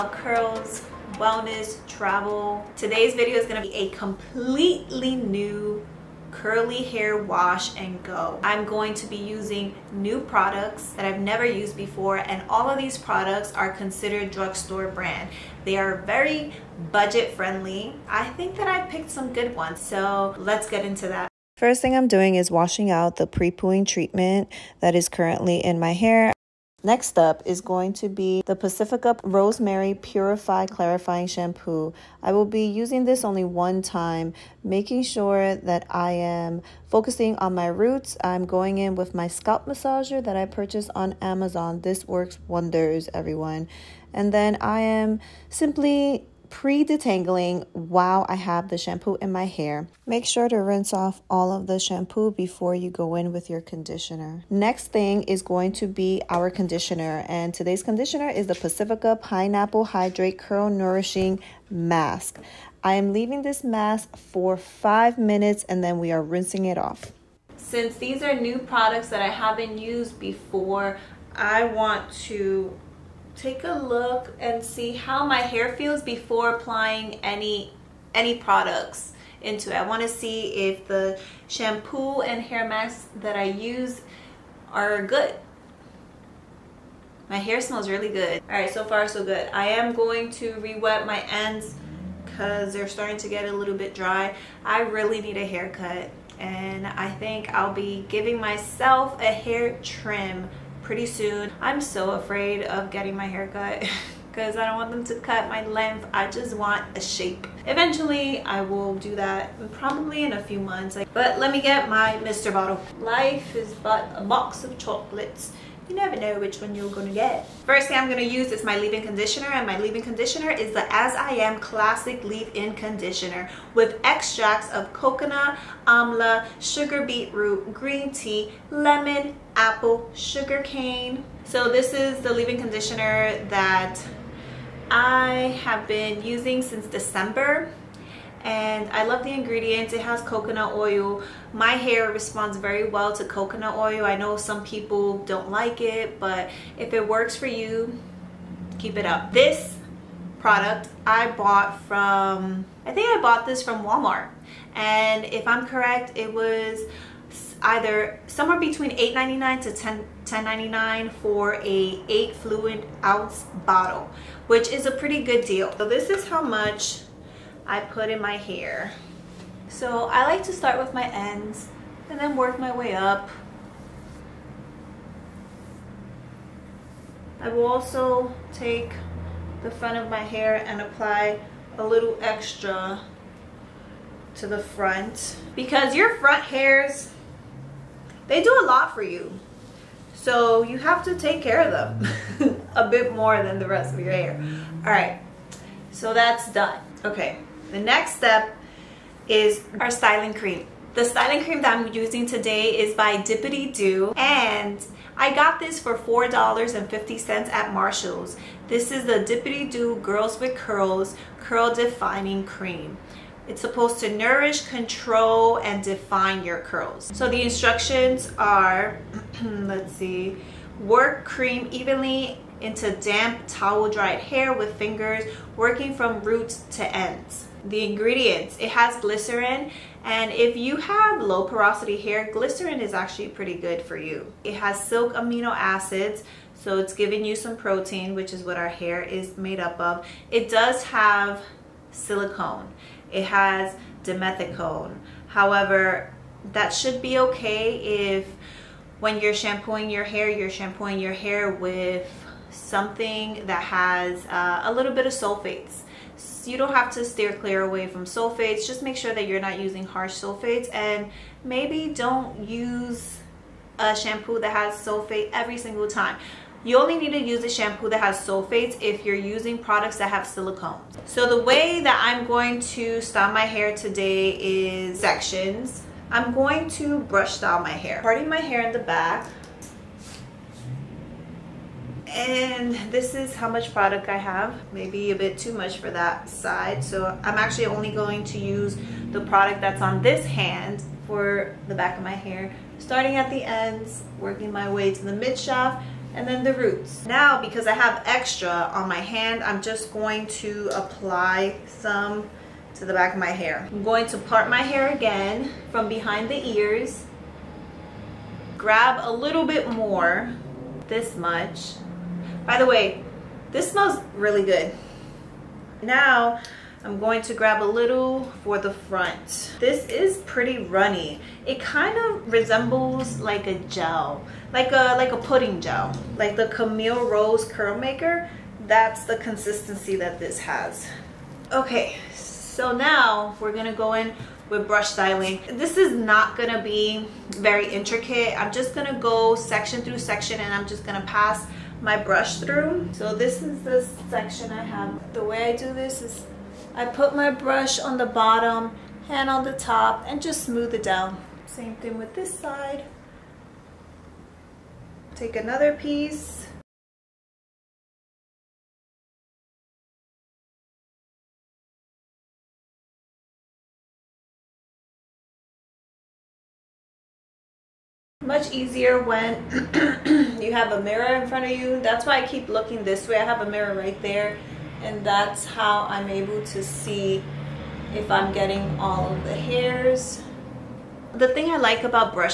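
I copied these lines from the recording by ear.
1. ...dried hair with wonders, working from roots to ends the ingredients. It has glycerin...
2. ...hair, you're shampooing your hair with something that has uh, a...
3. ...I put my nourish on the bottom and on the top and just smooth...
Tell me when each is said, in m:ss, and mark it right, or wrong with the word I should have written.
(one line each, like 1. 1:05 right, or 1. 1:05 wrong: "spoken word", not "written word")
1. 3:43 wrong: "fingers", not "wonders"
2. 4:10 right
3. 5:46 wrong: "brush", not "nourish".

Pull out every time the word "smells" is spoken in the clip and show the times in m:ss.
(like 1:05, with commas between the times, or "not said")
1:27, 5:13.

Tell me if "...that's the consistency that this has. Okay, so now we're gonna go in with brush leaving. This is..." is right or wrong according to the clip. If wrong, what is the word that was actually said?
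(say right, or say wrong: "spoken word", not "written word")
wrong: "styling", not "leaving".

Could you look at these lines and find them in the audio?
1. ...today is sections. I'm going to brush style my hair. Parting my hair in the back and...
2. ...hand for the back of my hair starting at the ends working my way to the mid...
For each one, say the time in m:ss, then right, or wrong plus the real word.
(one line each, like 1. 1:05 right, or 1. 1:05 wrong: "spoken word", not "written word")
1. 4:33 right
2. 4:50 right.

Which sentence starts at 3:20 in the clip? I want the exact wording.
The styling cream that I'm using today is by Dippity Do and I got this for $4.50 at Marshall's.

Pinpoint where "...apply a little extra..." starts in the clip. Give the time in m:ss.
3:00.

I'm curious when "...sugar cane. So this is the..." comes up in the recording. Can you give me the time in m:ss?
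2:10.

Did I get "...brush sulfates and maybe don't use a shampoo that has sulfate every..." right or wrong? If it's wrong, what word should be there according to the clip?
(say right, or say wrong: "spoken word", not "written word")
wrong: "harsh", not "brush".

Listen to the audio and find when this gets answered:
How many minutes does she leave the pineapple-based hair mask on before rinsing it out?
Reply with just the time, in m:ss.
1:04.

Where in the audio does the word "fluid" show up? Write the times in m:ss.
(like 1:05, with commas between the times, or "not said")
2:42.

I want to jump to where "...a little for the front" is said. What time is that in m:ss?
5:17.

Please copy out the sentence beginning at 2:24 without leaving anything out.
I know some people don't like it, but if it works for you, keep it up.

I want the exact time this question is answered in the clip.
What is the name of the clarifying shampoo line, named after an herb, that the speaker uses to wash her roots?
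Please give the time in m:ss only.
0:28.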